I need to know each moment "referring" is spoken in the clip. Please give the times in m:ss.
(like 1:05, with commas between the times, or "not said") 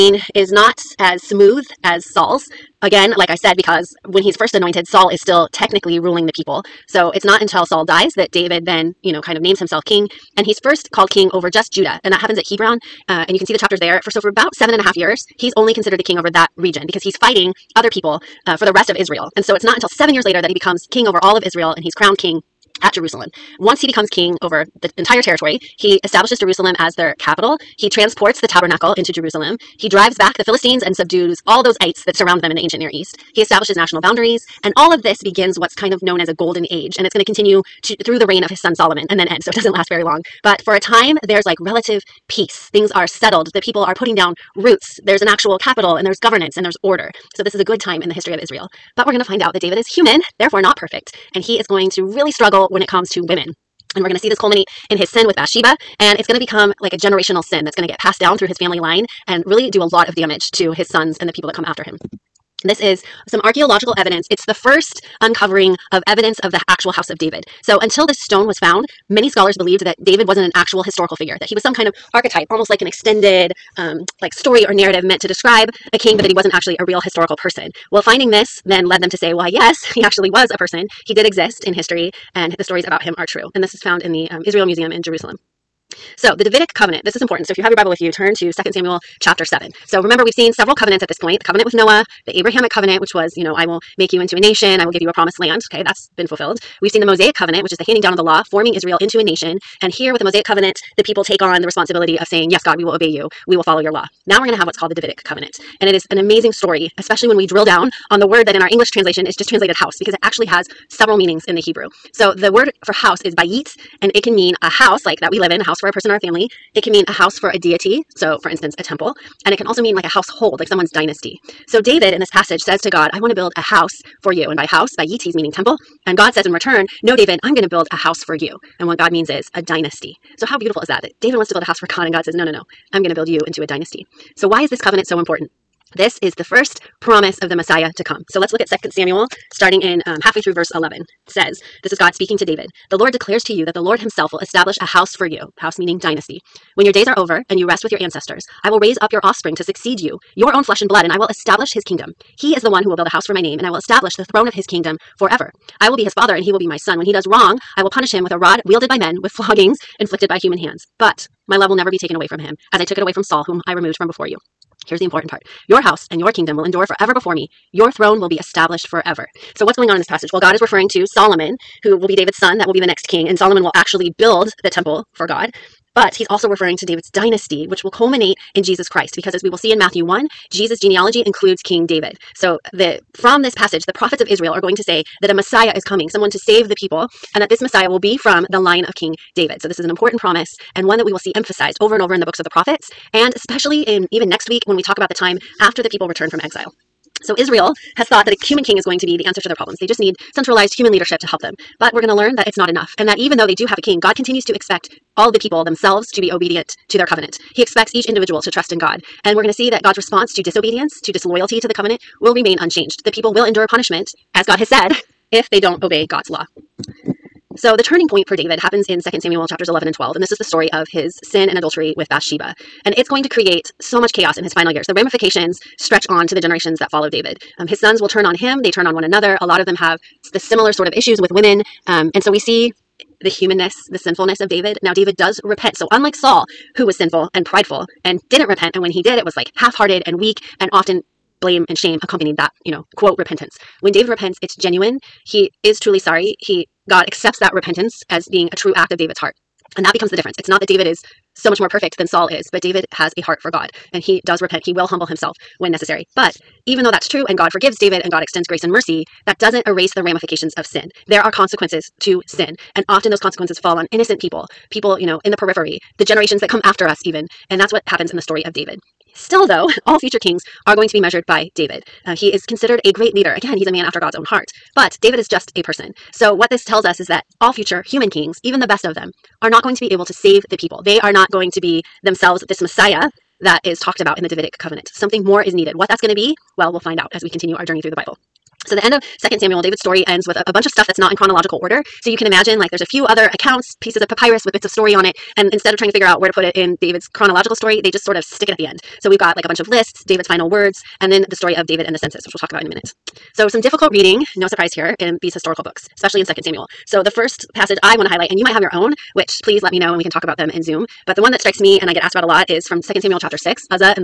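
2:50, 2:56.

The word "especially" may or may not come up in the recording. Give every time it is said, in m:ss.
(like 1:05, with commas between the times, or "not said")
1:46, 3:13, 5:05.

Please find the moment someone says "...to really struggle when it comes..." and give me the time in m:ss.
0:51.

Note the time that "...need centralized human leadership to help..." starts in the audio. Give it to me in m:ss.
3:19.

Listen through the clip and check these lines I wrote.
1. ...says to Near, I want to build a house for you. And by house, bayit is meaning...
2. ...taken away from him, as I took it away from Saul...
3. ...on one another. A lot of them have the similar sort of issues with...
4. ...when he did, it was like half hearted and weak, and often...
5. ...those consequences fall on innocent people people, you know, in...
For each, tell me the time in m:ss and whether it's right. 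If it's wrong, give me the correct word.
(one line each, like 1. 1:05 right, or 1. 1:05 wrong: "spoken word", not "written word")
1. 2:02 wrong: "God", not "Near"
2. 2:41 right
3. 3:48 right
4. 3:58 right
5. 4:23 right.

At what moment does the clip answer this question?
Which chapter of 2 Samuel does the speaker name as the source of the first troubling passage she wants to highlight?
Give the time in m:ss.
5:13.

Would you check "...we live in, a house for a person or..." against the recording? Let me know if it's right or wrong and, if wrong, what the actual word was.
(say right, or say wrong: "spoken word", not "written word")
right.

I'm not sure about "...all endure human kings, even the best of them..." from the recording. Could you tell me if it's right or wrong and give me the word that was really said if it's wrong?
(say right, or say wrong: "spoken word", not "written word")
wrong: "future", not "endure".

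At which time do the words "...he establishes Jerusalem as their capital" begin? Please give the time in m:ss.
0:25.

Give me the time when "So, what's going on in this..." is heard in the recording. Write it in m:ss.
2:49.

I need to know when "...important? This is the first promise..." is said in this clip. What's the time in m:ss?
2:15.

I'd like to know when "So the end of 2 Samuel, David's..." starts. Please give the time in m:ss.
4:48.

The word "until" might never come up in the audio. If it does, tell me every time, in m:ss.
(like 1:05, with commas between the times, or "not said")
0:07, 0:19, 1:07.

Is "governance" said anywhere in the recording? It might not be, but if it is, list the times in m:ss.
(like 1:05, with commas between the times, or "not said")
0:46.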